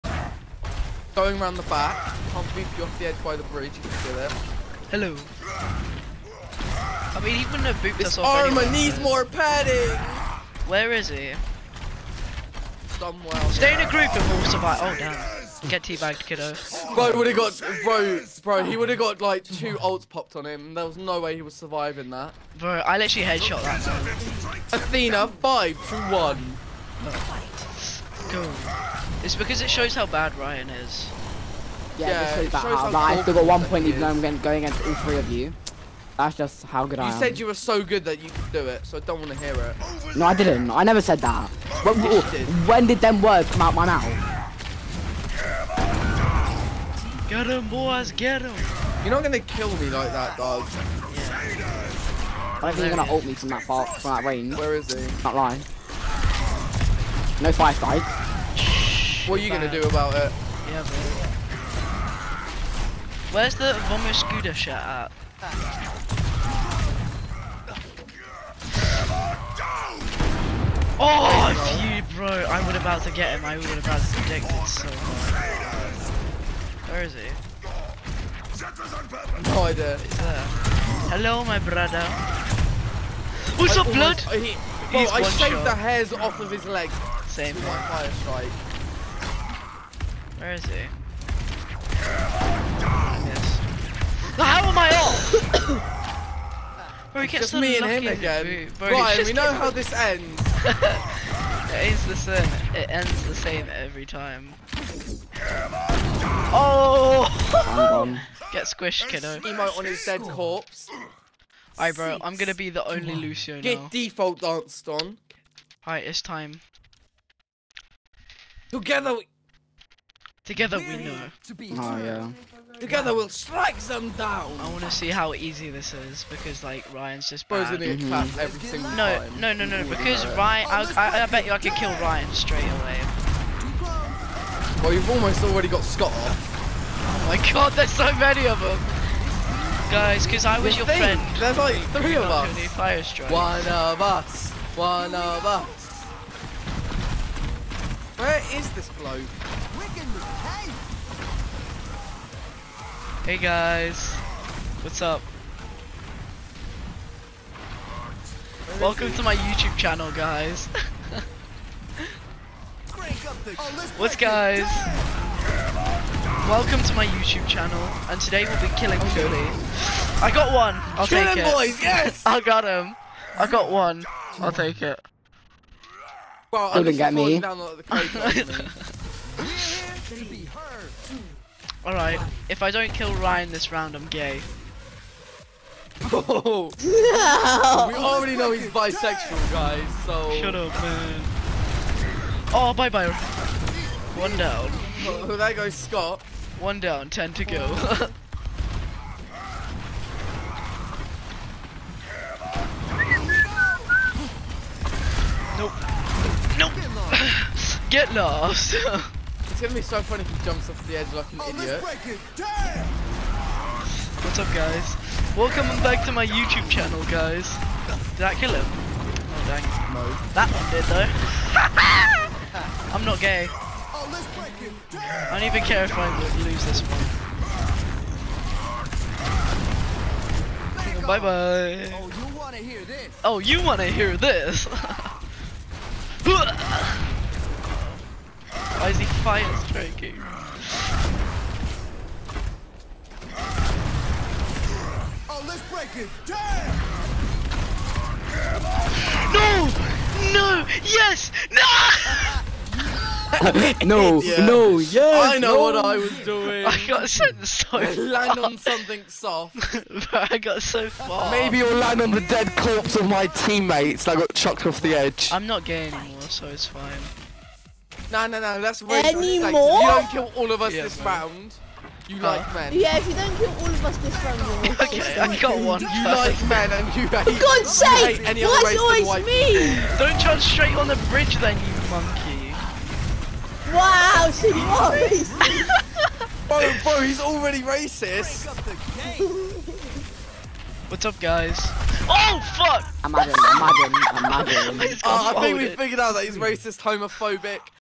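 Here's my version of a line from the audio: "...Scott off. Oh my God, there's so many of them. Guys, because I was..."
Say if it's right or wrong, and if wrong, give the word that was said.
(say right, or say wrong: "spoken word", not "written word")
right.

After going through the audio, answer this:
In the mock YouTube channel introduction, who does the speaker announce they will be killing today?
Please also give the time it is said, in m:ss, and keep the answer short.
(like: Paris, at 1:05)
Philly, at 2:48.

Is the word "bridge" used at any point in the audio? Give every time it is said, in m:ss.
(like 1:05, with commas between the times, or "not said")
0:03, 4:41.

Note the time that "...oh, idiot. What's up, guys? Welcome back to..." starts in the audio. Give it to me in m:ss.
3:31.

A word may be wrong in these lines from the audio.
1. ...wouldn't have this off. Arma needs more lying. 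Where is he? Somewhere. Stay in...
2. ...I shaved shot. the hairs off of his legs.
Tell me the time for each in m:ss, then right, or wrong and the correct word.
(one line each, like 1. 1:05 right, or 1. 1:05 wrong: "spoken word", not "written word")
1. 0:07 wrong: "padding", not "lying"
2. 1:25 right.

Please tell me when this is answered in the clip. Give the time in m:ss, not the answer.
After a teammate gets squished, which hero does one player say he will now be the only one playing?
1:53.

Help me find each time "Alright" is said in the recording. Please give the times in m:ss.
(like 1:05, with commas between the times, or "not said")
1:51, 1:55, 3:01.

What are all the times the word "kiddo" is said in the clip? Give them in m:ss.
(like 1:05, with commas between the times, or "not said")
0:16, 1:49.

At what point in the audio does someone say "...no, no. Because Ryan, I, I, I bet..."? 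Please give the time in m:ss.
2:09.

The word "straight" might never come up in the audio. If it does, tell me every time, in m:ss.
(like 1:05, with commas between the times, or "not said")
2:12, 4:40.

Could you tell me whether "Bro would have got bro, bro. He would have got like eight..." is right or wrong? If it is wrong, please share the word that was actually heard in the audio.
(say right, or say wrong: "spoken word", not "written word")
wrong: "two", not "eight".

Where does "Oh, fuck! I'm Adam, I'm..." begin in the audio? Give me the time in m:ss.
4:51.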